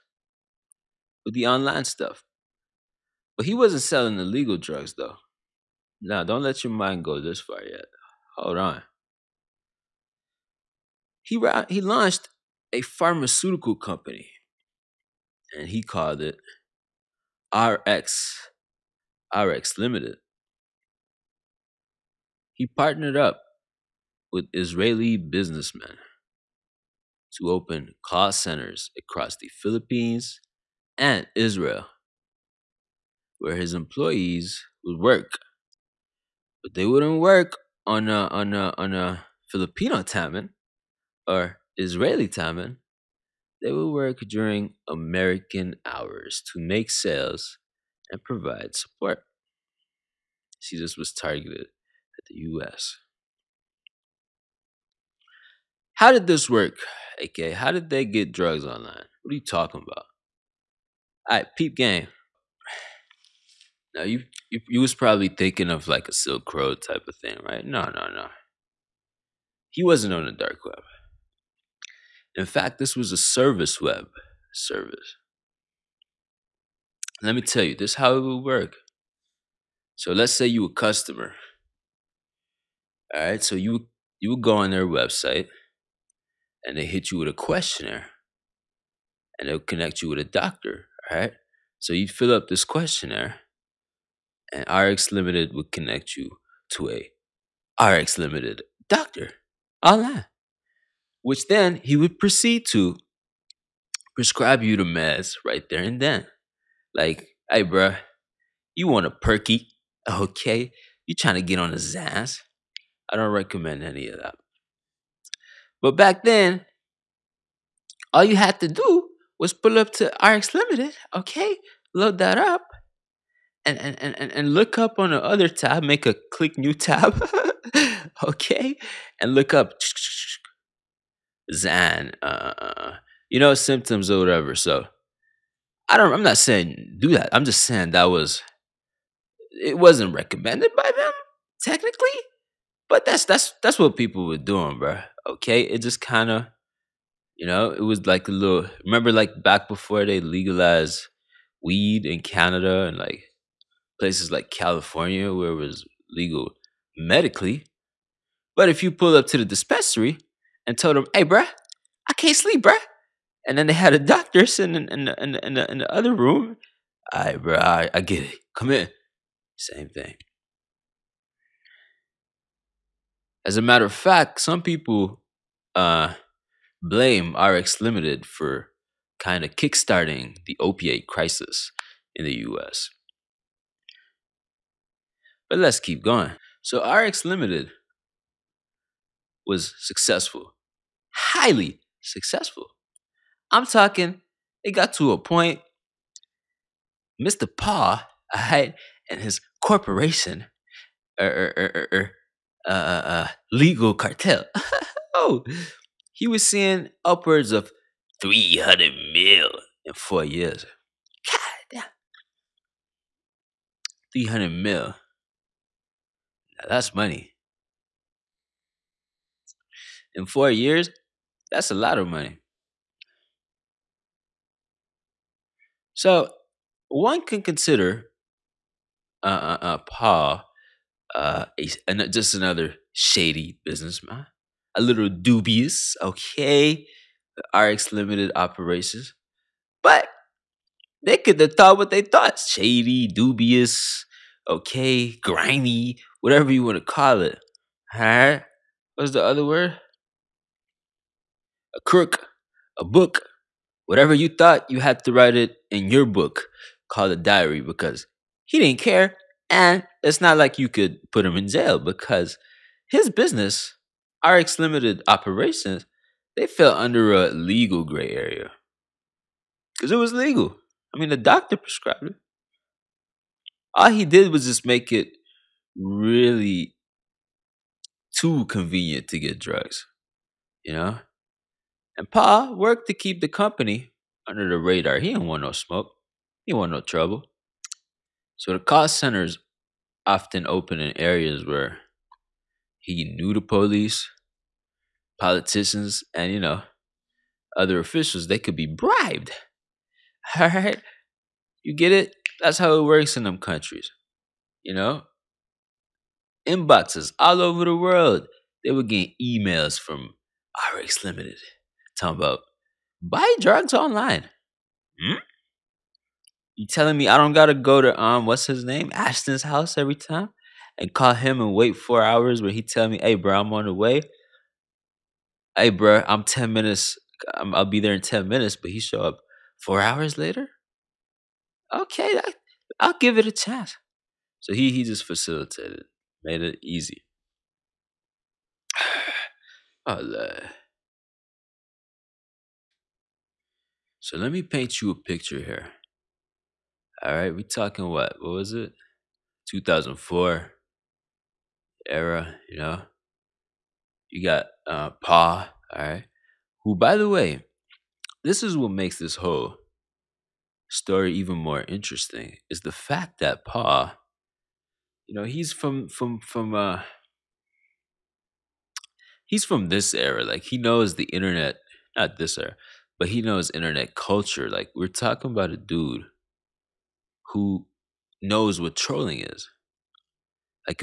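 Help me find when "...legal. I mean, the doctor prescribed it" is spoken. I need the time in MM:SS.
04:30.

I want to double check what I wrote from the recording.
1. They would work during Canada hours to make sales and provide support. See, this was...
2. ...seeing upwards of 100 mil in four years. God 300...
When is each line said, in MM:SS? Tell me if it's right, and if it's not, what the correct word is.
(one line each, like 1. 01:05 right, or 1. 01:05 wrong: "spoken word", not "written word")
1. 00:43 wrong: "American", not "Canada"
2. 03:26 wrong: "300", not "100".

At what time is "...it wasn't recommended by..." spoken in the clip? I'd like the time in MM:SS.
02:19.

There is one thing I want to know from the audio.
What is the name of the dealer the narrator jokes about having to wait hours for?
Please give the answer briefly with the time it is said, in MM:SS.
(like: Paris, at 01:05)
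Ashton, at 05:18.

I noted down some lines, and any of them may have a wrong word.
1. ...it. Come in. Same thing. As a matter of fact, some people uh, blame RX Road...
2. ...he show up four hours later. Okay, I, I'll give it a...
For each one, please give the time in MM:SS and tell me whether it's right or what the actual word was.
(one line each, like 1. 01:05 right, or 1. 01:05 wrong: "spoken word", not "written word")
1. 02:48 wrong: "Limited", not "Road"
2. 05:28 right.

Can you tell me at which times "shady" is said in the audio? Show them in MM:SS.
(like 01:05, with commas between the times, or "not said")
03:52, 04:02.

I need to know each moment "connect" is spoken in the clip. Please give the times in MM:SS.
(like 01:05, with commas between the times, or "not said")
01:29, 01:35.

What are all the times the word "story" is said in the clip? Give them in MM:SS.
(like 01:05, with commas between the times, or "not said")
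06:00.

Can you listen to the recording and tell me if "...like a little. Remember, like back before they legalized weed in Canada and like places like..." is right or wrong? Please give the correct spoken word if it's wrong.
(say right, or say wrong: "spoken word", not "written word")
right.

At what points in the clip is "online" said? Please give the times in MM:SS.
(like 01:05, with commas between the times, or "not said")
00:01, 00:58, 01:39, 05:13.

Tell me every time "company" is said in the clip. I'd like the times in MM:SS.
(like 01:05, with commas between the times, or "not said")
00:13, 04:43.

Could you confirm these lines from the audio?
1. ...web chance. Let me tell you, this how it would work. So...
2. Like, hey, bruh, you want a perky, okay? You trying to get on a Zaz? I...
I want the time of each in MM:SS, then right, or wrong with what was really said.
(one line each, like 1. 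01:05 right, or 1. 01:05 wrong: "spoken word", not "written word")
1. 01:13 wrong: "service", not "chance"
2. 01:46 right.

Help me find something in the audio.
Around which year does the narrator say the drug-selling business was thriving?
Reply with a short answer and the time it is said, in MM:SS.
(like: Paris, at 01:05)
2004, at 05:49.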